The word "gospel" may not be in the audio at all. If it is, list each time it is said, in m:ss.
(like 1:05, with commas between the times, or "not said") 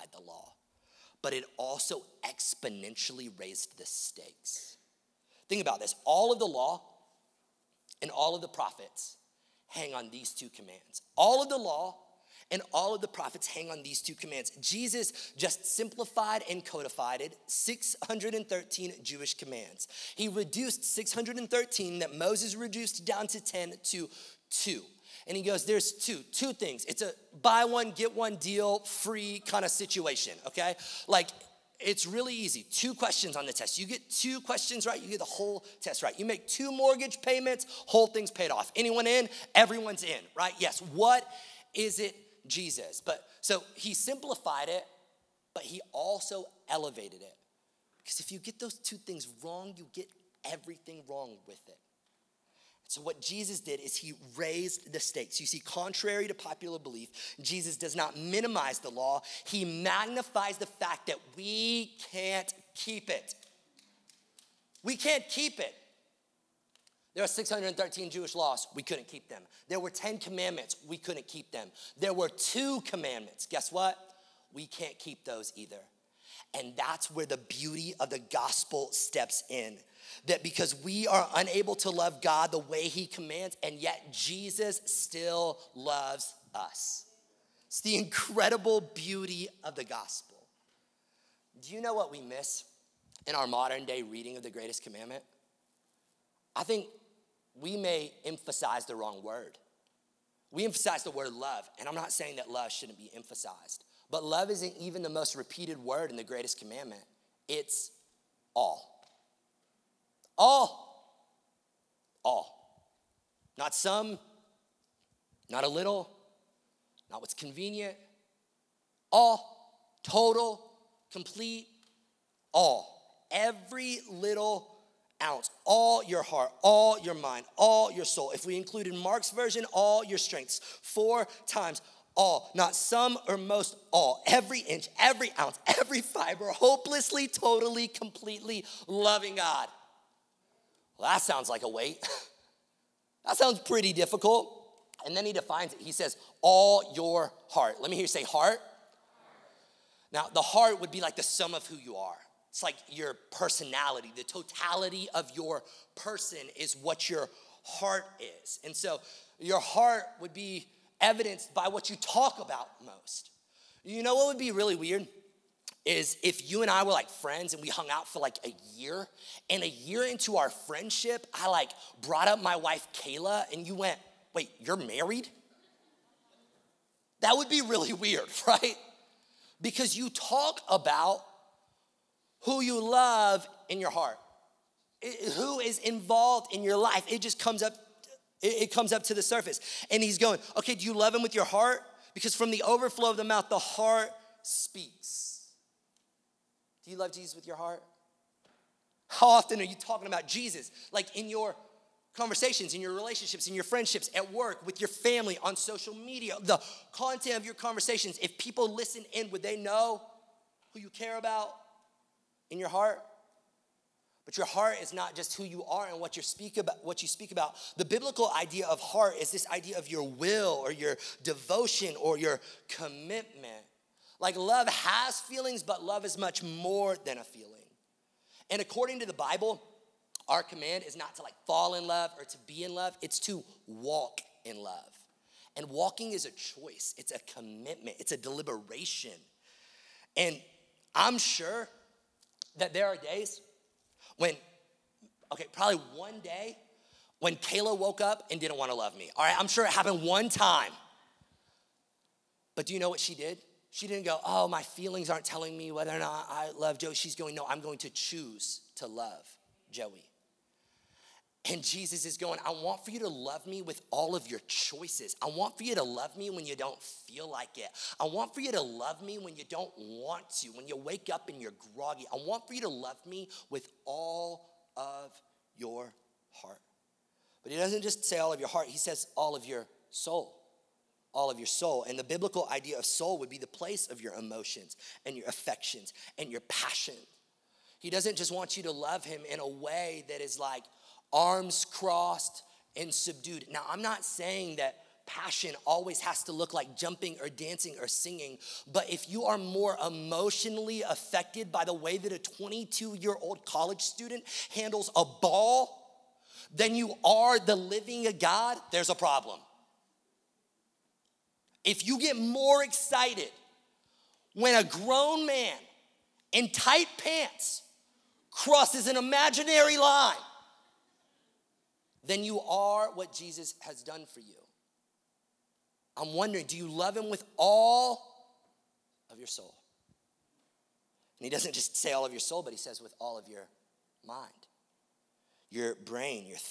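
1:18, 1:29.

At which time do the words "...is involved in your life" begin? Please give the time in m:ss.
3:05.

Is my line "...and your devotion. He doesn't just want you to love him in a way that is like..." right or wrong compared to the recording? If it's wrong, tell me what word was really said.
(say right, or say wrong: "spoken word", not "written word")
wrong: "passion", not "devotion".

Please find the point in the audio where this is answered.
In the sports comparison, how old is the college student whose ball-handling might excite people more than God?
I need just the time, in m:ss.
5:02.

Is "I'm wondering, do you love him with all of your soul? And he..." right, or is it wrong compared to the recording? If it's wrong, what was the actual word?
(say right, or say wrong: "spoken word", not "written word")
right.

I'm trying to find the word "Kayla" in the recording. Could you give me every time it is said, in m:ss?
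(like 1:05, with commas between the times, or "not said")
2:52, 4:07.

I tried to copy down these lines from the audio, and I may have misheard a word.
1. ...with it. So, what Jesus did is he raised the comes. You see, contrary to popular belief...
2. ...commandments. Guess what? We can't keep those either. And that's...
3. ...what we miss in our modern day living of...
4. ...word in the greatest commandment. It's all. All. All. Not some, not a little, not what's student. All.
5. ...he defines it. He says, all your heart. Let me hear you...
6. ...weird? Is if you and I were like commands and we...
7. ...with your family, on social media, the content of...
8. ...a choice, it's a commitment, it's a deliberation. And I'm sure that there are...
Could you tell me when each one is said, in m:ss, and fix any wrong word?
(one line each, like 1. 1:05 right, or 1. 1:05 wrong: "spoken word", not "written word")
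1. 0:51 wrong: "stakes", not "comes"
2. 1:12 right
3. 1:31 wrong: "reading", not "living"
4. 1:45 wrong: "convenient", not "student"
5. 2:25 right
6. 2:44 wrong: "friends", not "commands"
7. 3:24 right
8. 3:56 right.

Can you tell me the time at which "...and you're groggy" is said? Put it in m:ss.
4:31.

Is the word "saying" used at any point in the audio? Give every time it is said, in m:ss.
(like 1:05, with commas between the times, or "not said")
1:42, 4:54.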